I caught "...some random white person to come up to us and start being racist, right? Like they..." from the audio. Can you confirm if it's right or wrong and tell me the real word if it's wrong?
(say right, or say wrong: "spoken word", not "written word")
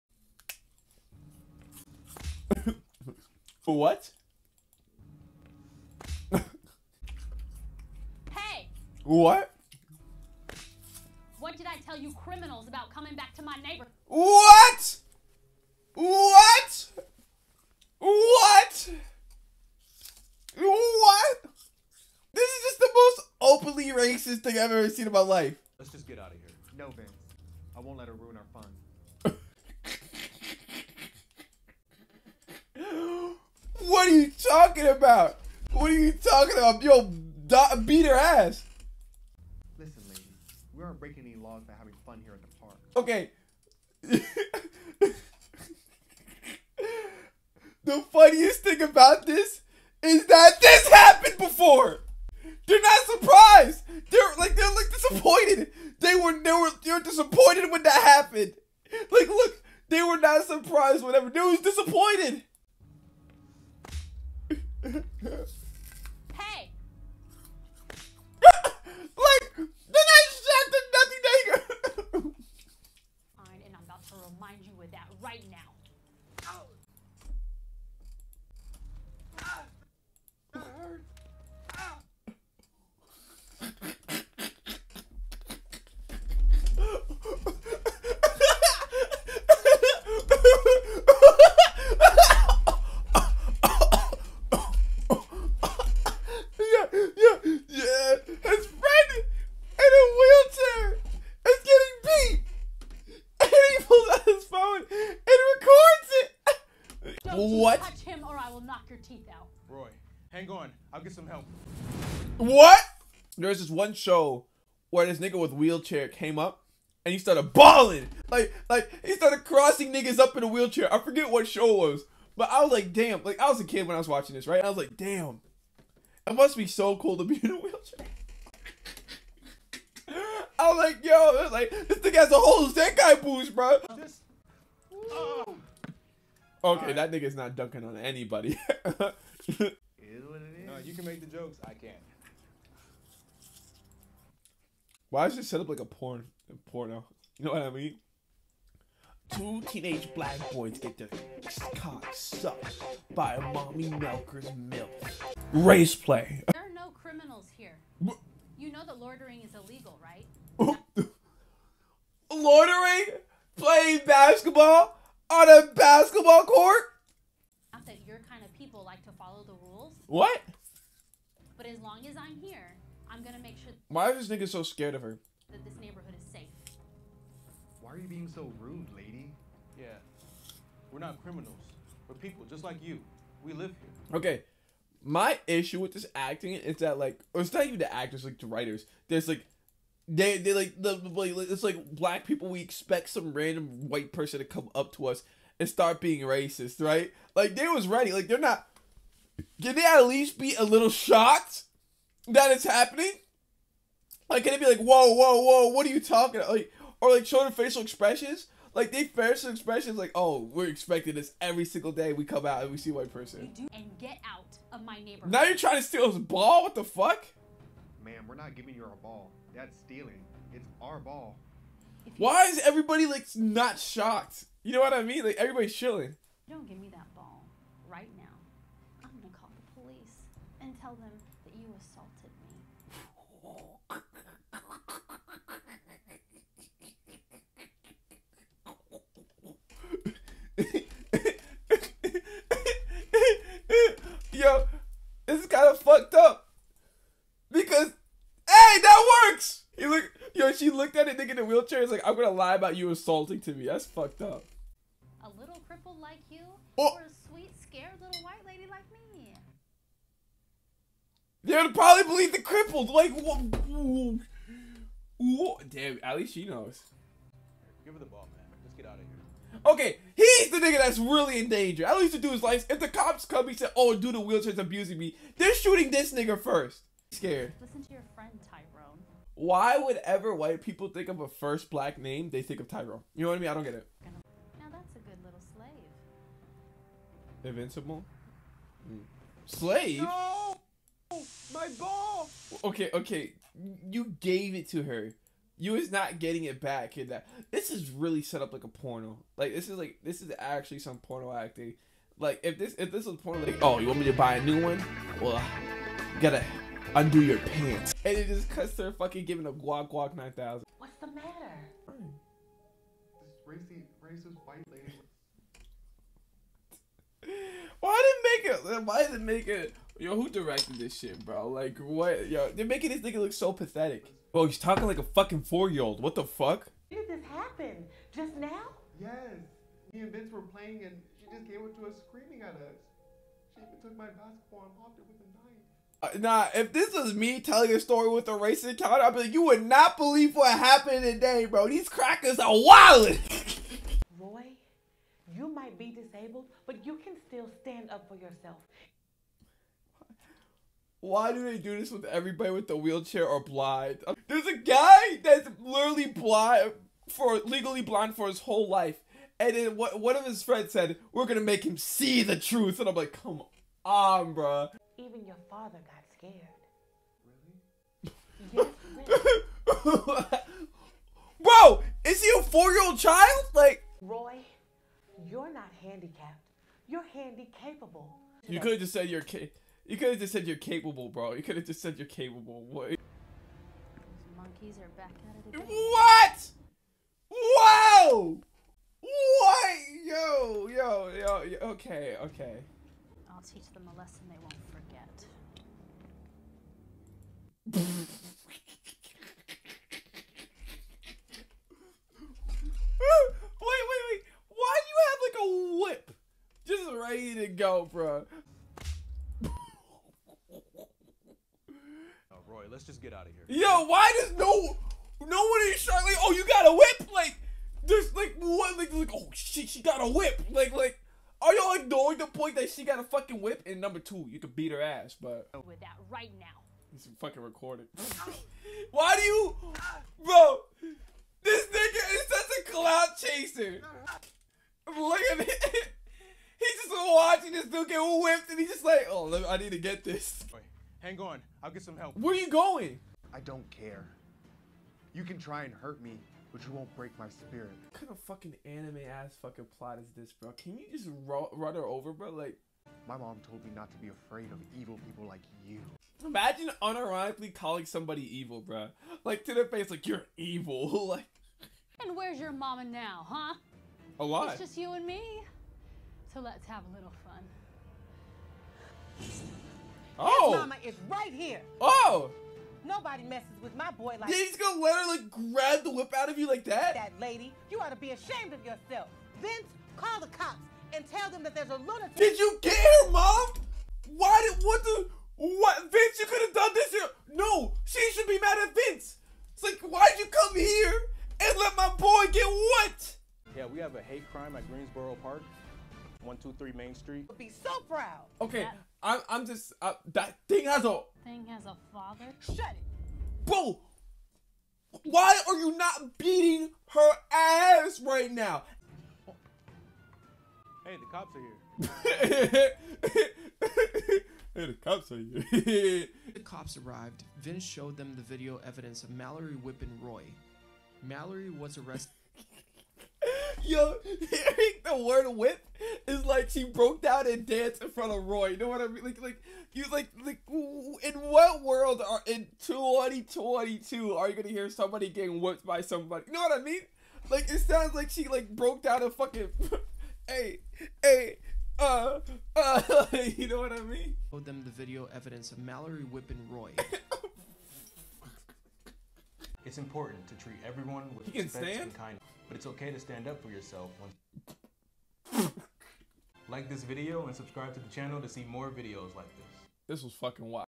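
right.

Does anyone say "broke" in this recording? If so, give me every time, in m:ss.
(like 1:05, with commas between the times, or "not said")
8:46, 8:58.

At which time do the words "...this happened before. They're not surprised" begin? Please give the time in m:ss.
0:50.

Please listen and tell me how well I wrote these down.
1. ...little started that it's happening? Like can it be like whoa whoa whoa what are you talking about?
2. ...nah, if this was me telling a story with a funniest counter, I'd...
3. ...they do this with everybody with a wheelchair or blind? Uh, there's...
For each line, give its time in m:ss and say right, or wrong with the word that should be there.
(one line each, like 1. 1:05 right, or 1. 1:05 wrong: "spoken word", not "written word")
1. 3:20 wrong: "shocked", not "started"
2. 5:36 wrong: "racist", not "funniest"
3. 5:51 right.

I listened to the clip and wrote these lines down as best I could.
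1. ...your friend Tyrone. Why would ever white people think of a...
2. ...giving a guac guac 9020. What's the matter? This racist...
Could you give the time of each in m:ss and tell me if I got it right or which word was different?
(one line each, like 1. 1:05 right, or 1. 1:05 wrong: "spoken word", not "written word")
1. 4:37 right
2. 5:09 wrong: "9000", not "9020".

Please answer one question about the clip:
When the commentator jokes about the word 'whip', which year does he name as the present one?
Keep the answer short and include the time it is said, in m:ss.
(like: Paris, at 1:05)
2022, at 8:52.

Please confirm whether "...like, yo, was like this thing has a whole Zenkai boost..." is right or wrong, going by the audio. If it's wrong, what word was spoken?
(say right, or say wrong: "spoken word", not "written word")
right.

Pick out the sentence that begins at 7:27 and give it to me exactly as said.
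What kind of fucking anime ass fucking plot is this, bro?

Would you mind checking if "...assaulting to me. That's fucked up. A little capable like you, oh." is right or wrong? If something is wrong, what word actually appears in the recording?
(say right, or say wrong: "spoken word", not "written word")
wrong: "cripple", not "capable".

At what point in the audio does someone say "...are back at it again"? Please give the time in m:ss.
6:24.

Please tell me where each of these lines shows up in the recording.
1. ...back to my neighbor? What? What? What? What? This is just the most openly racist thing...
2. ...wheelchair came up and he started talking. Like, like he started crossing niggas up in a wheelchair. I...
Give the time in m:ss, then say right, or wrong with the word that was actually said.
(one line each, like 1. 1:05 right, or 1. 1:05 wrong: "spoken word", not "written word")
1. 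0:13 right
2. 1:55 wrong: "bawling", not "talking".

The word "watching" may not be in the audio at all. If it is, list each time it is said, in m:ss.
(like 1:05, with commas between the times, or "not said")
2:04, 7:17.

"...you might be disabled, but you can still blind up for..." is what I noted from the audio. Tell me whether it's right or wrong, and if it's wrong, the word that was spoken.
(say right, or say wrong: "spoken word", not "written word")
wrong: "stand", not "blind".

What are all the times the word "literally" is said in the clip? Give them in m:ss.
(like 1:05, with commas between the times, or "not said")
5:55.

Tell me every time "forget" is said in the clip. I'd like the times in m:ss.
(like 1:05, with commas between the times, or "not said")
2:00, 6:34.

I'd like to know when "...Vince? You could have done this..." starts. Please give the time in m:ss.
8:05.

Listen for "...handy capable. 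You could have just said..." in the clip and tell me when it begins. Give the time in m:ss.
6:17.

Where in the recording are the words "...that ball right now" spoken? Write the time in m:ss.
3:46.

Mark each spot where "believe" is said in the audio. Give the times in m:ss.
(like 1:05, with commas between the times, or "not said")
4:22, 5:39.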